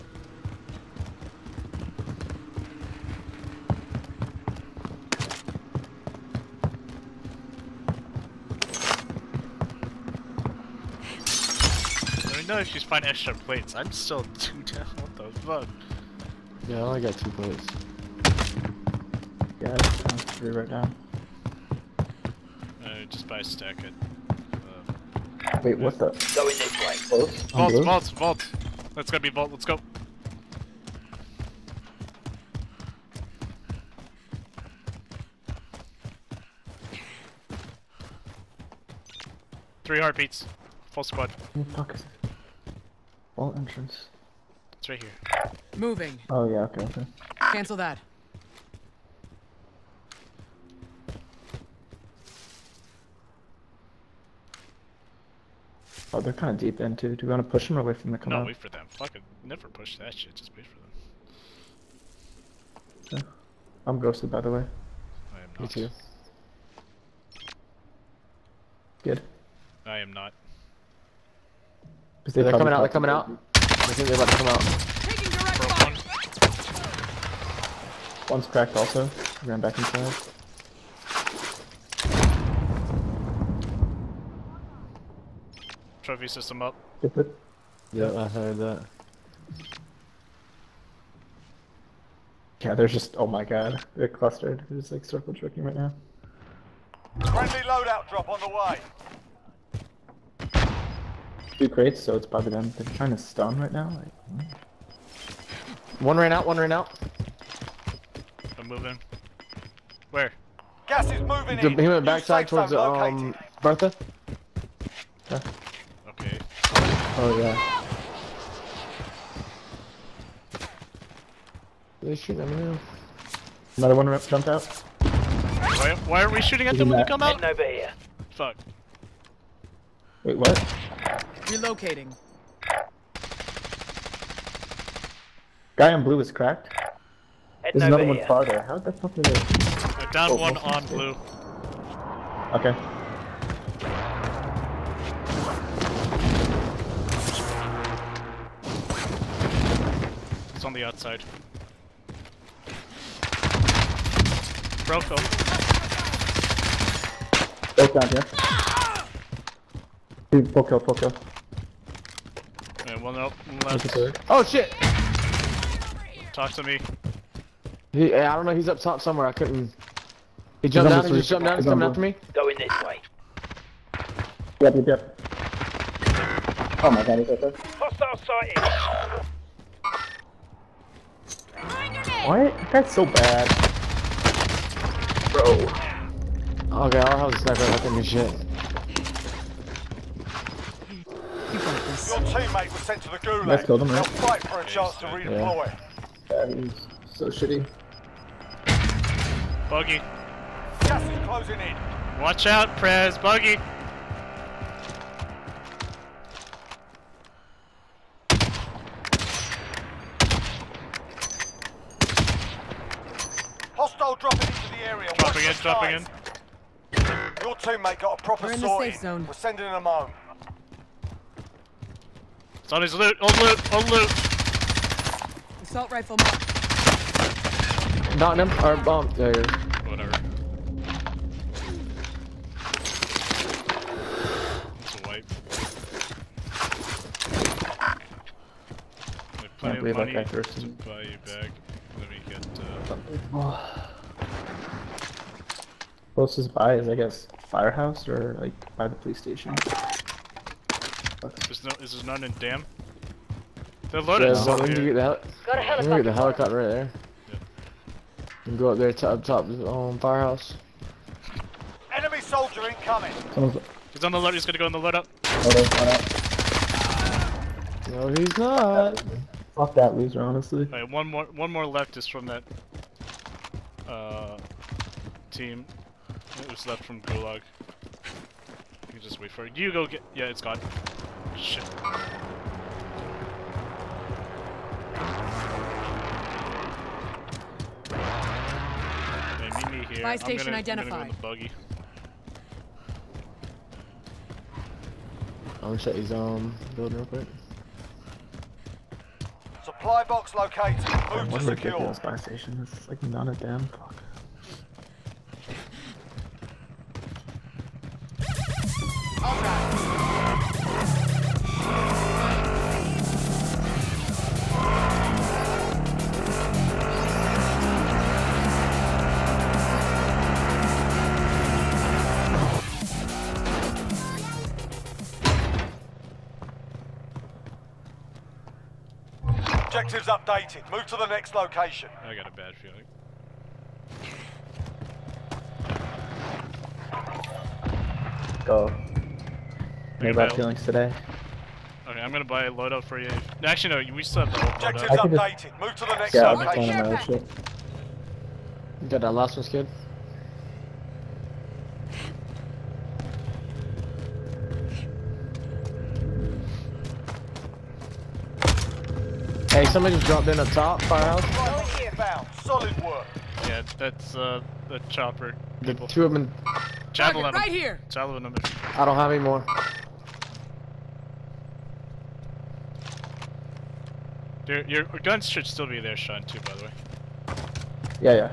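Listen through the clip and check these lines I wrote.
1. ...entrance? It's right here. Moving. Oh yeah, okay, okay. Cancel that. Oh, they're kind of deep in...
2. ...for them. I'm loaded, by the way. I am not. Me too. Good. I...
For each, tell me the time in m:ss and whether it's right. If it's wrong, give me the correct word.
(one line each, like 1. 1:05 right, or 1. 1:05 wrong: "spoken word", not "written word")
1. 0:43 right
2. 1:03 wrong: "ghosted", not "loaded".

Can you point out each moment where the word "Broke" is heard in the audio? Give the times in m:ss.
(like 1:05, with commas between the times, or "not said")
2:34.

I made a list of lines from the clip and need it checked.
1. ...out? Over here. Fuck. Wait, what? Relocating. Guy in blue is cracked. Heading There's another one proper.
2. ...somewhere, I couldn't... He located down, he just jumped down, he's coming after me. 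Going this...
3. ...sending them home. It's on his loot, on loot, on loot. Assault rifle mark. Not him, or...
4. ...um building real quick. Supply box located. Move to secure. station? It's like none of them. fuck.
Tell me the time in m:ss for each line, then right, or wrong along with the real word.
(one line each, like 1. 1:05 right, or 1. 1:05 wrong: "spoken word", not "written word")
1. 2:07 wrong: "farther", not "proper"
2. 2:48 wrong: "jumped", not "located"
3. 3:39 right
4. 4:56 right.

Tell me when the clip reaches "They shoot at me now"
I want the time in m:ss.
2:02.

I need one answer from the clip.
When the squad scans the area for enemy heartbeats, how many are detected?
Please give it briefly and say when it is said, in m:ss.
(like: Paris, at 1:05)
3, at 0:39.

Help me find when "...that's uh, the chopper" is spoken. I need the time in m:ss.
6:03.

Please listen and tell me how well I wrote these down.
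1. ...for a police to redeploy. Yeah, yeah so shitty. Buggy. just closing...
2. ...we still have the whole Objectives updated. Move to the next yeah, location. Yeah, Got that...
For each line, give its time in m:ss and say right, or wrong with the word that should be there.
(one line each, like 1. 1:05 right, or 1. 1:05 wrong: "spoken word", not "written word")
1. 3:14 wrong: "chance", not "police"
2. 5:43 right.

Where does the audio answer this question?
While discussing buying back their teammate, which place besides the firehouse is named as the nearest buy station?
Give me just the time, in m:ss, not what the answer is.
4:08.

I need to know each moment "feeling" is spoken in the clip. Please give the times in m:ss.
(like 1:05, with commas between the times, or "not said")
5:32, 5:40.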